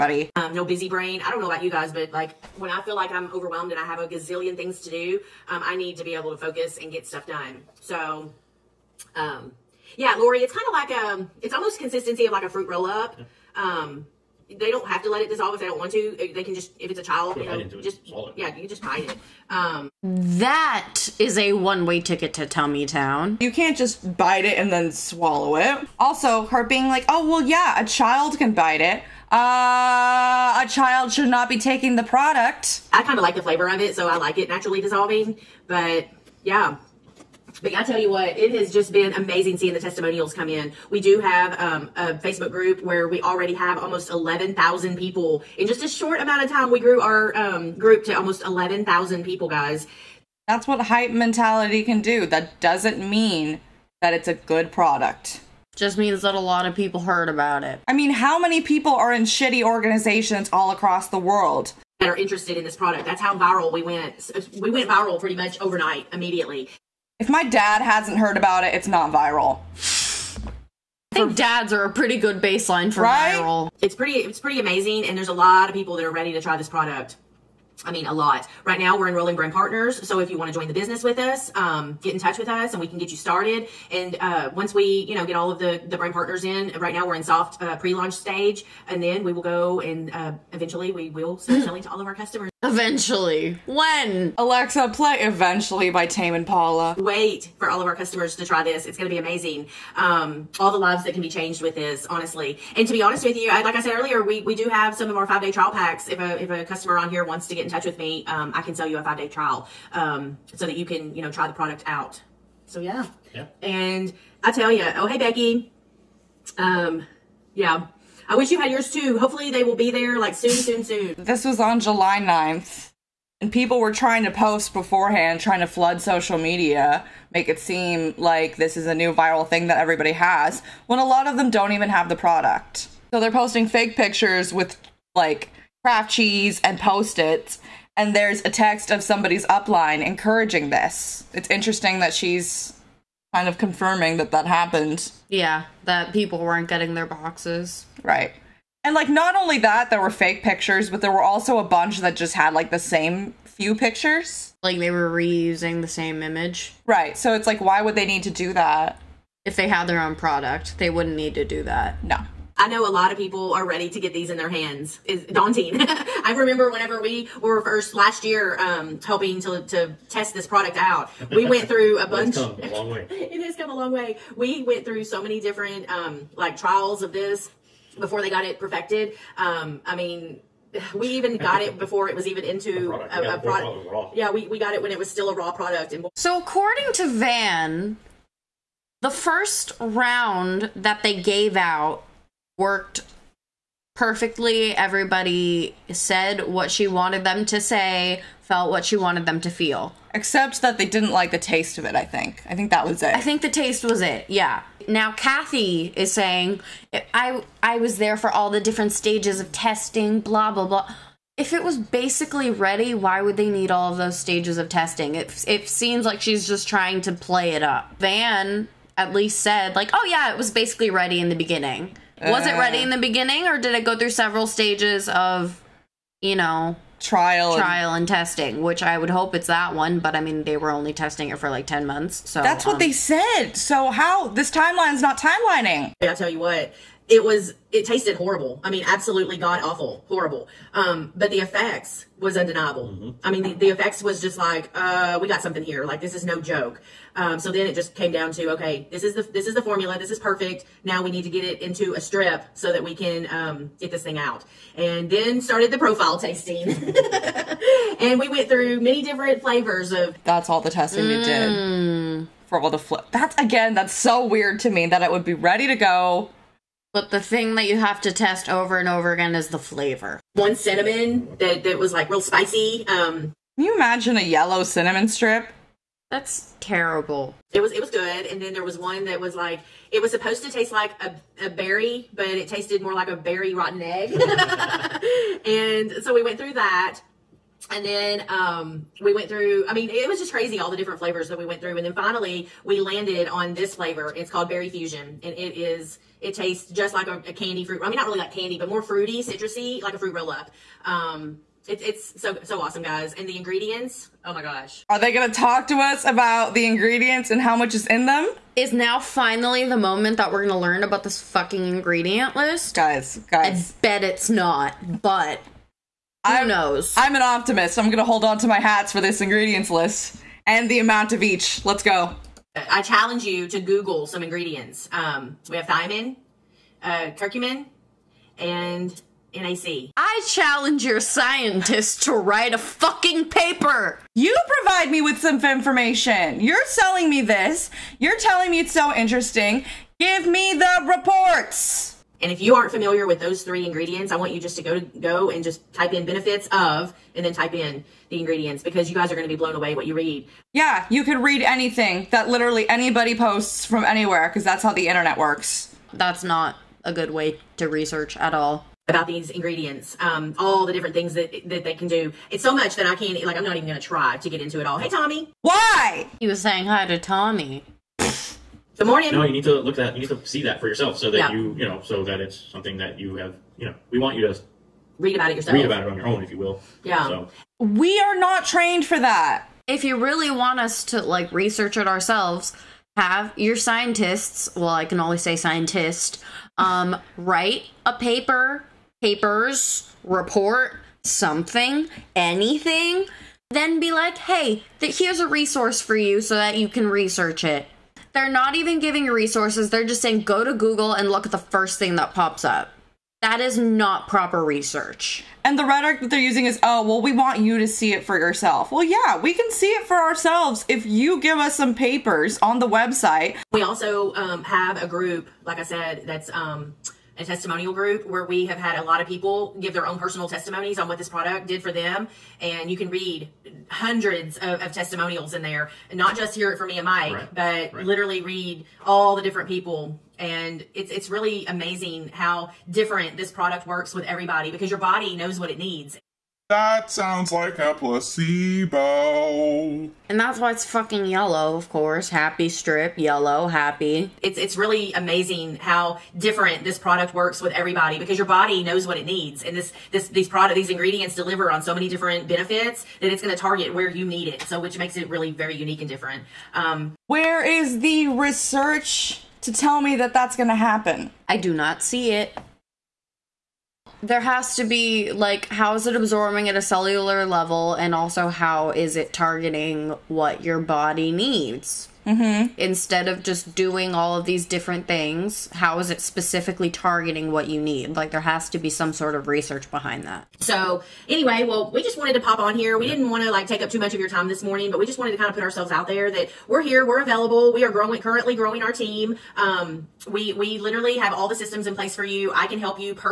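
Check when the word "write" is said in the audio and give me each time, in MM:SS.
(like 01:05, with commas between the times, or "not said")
05:32, 06:27.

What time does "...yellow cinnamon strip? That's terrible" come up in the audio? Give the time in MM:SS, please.
04:34.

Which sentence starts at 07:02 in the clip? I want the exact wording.
And you can read hundreds of, of testimonials in there and not just hear it from me and Mike, right.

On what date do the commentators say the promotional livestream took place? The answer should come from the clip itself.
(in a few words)
July 9th.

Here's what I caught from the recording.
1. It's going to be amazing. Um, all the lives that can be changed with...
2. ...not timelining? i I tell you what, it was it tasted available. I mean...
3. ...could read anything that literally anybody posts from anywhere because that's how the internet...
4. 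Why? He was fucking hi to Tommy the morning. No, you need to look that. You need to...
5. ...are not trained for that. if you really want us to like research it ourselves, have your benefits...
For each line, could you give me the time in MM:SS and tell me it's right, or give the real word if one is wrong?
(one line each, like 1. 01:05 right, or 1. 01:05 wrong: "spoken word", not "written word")
1. 01:38 right
2. 03:55 wrong: "horrible", not "available"
3. 05:51 right
4. 06:05 wrong: "saying", not "fucking"
5. 06:18 wrong: "scientists", not "benefits".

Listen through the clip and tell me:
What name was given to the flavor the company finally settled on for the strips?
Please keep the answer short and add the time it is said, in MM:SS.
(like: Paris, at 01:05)
Berry Fusion, at 04:54.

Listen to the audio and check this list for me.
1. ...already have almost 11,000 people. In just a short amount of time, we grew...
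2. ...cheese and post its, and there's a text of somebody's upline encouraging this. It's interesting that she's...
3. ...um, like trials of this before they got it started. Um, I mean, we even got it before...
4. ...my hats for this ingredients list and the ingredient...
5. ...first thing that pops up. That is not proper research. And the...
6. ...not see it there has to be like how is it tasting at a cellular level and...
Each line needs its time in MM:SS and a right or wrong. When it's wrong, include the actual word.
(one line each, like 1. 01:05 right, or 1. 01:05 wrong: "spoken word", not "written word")
1. 00:43 right
2. 02:16 right
3. 02:55 wrong: "perfected", not "started"
4. 05:18 wrong: "amount", not "ingredient"
5. 06:41 right
6. 07:41 wrong: "absorbing", not "tasting".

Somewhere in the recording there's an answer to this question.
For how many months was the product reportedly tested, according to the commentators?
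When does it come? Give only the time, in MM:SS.
03:51.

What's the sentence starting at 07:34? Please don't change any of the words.
So which makes it really very unique and different.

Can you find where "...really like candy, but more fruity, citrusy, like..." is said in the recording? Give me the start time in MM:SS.
04:58.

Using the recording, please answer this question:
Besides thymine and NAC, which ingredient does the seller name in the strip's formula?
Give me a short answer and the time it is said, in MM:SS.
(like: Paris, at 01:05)
Curcumin, at 05:27.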